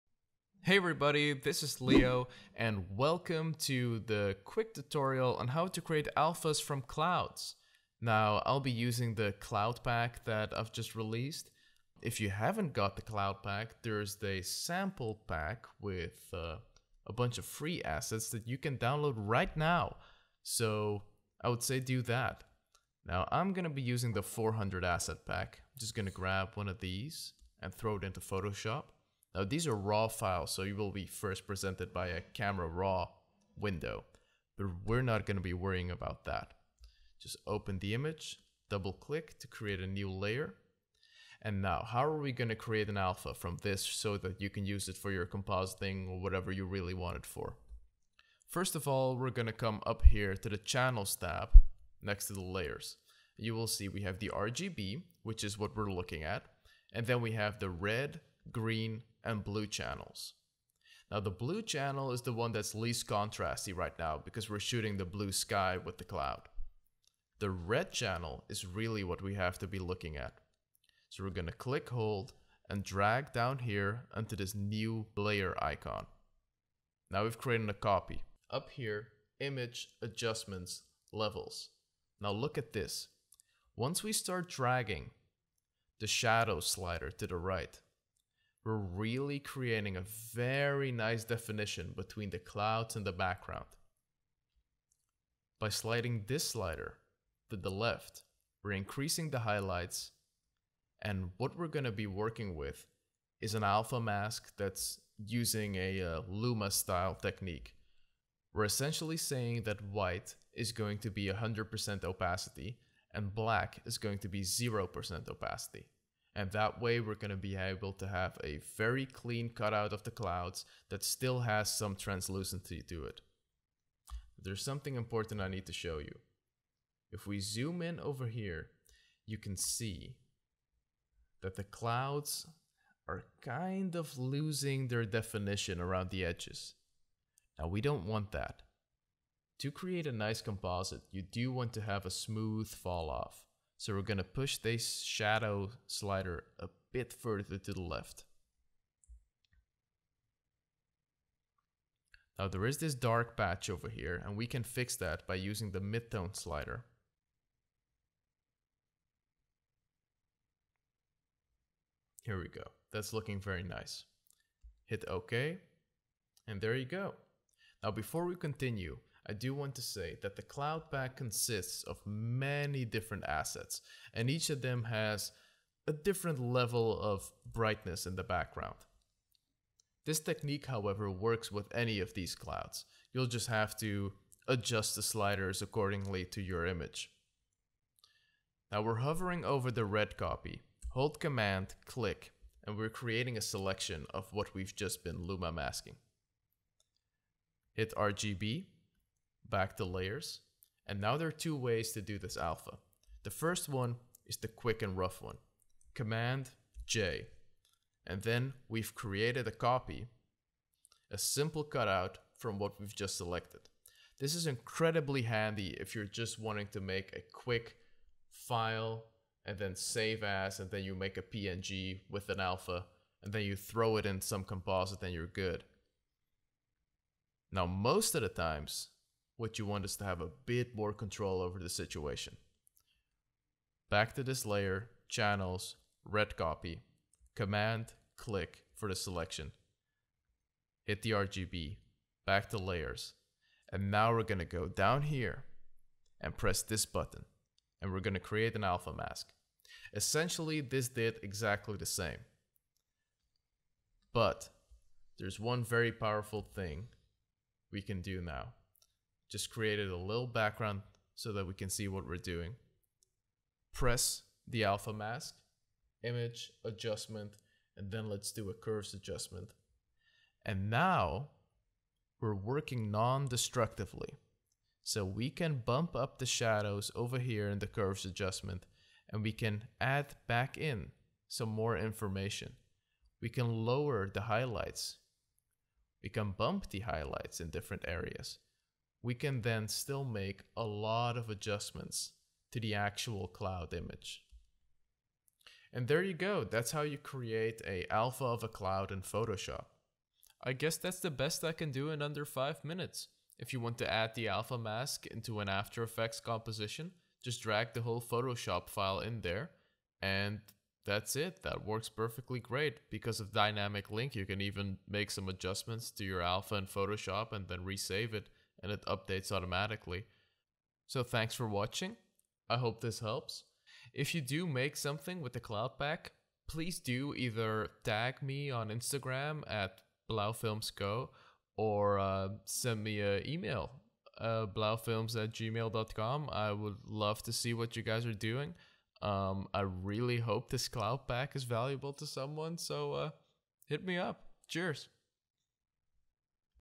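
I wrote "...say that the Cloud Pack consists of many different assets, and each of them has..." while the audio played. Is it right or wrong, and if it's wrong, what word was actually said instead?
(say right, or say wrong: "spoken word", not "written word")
right.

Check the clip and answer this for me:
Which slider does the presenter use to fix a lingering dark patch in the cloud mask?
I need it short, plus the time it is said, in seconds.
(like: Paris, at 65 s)
Midtone slider, at 155 s.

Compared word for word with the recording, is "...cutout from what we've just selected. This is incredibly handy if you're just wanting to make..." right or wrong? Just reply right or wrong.
right.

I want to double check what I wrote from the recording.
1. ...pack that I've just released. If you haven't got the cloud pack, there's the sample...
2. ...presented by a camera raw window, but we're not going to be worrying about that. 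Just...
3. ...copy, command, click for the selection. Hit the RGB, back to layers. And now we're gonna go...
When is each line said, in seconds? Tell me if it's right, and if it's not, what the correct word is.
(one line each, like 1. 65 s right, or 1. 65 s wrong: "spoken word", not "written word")
1. 9 s right
2. 31 s right
3. 236 s right.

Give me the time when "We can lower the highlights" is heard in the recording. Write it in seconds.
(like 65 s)
283 s.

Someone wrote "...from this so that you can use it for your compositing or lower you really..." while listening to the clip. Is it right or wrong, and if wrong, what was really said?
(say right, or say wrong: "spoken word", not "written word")
wrong: "whatever", not "lower".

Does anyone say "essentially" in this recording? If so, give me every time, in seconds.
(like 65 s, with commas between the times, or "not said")
108 s, 249 s.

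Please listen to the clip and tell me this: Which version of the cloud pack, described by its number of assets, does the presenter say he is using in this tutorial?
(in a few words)
400 asset pack.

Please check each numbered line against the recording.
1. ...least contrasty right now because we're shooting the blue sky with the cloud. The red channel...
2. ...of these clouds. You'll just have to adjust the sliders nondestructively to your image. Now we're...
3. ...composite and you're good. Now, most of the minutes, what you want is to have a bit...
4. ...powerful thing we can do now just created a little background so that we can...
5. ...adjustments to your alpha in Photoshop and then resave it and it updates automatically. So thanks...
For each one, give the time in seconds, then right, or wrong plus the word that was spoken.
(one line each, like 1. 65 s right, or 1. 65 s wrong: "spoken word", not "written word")
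1. 62 s right
2. 181 s wrong: "accordingly", not "nondestructively"
3. 224 s wrong: "times", not "minutes"
4. 255 s right
5. 315 s right.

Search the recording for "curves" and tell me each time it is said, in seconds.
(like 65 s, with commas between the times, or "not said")
268 s, 277 s.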